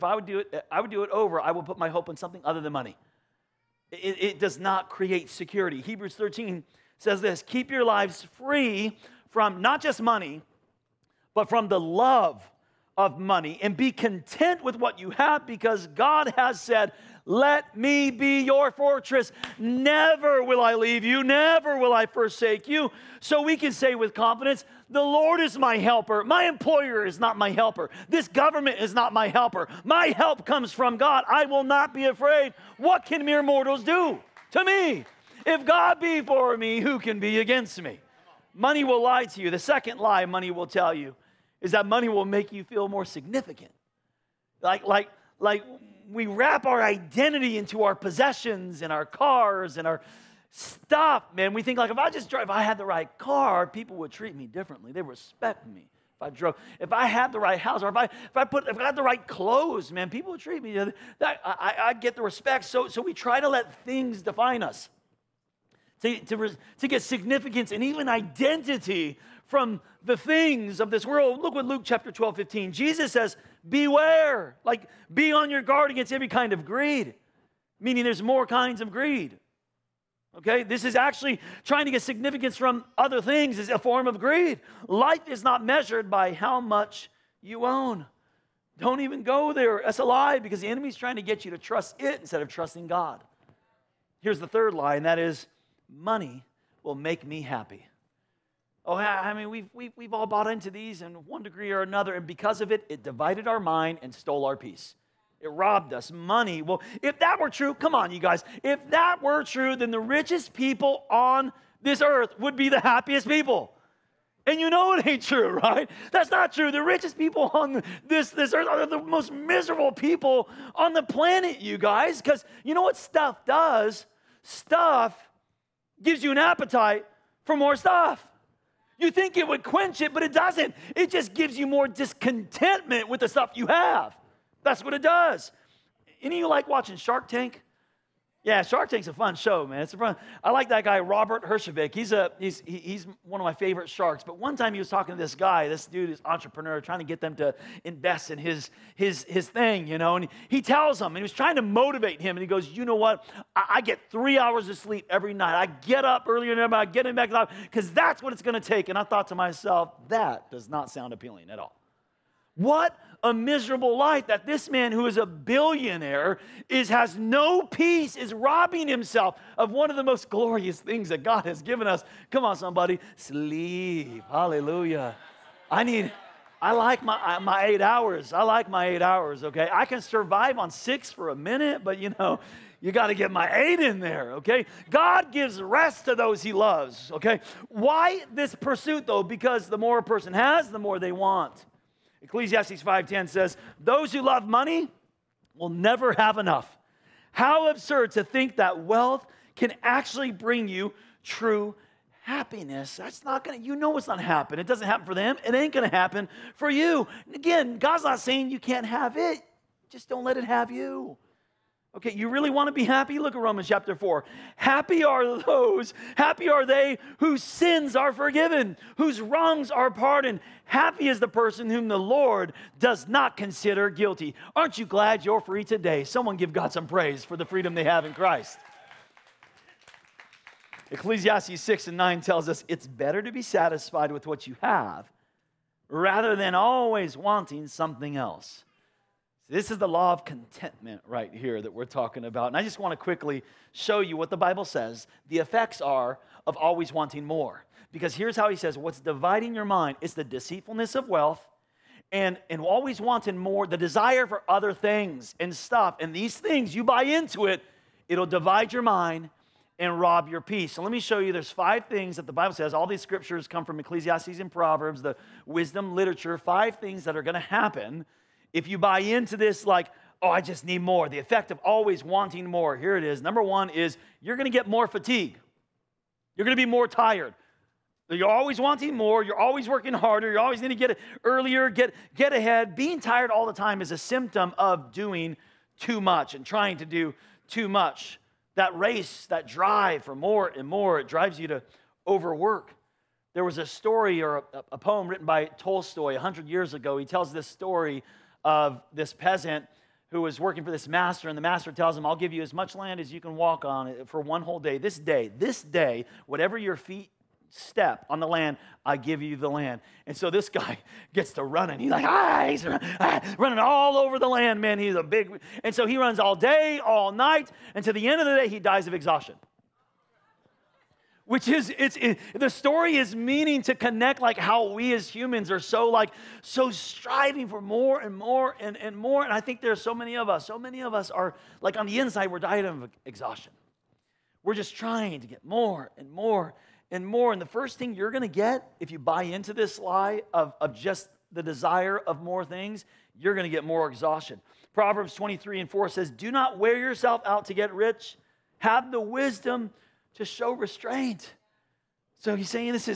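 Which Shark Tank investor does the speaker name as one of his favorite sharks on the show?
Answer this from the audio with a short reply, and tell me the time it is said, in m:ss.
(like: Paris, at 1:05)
Robert Herjavec, at 2:20.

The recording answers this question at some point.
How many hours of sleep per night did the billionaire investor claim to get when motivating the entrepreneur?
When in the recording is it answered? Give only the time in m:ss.
2:34.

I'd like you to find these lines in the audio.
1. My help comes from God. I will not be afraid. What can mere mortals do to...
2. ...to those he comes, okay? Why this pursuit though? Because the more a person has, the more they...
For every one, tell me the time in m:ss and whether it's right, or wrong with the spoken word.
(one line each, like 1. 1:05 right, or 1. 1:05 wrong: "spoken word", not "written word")
1. 0:29 right
2. 3:06 wrong: "loves", not "comes".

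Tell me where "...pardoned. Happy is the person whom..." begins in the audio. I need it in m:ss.
3:39.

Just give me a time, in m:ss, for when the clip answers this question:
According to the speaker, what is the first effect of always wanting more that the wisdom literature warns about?
4:34.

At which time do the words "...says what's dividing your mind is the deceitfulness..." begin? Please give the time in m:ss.
4:08.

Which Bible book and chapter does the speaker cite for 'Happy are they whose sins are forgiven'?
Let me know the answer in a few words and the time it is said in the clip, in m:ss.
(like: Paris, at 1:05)
Romans chapter 4, at 3:33.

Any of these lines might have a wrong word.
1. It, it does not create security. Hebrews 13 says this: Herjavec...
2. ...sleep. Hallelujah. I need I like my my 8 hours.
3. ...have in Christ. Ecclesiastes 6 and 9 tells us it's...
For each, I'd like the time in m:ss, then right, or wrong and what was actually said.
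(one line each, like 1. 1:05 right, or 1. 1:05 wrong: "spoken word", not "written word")
1. 0:03 wrong: "Keep", not "Herjavec"
2. 2:53 right
3. 3:47 right.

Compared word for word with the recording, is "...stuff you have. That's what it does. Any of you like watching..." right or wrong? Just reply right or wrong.
right.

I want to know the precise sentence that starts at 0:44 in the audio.
Like, like, like we wrap our identity into our possessions and our cars and our stuff, man.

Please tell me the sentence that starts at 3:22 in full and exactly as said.
That's not going to, you know, it's not happen.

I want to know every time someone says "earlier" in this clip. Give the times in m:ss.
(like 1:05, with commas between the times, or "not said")
2:36, 4:41.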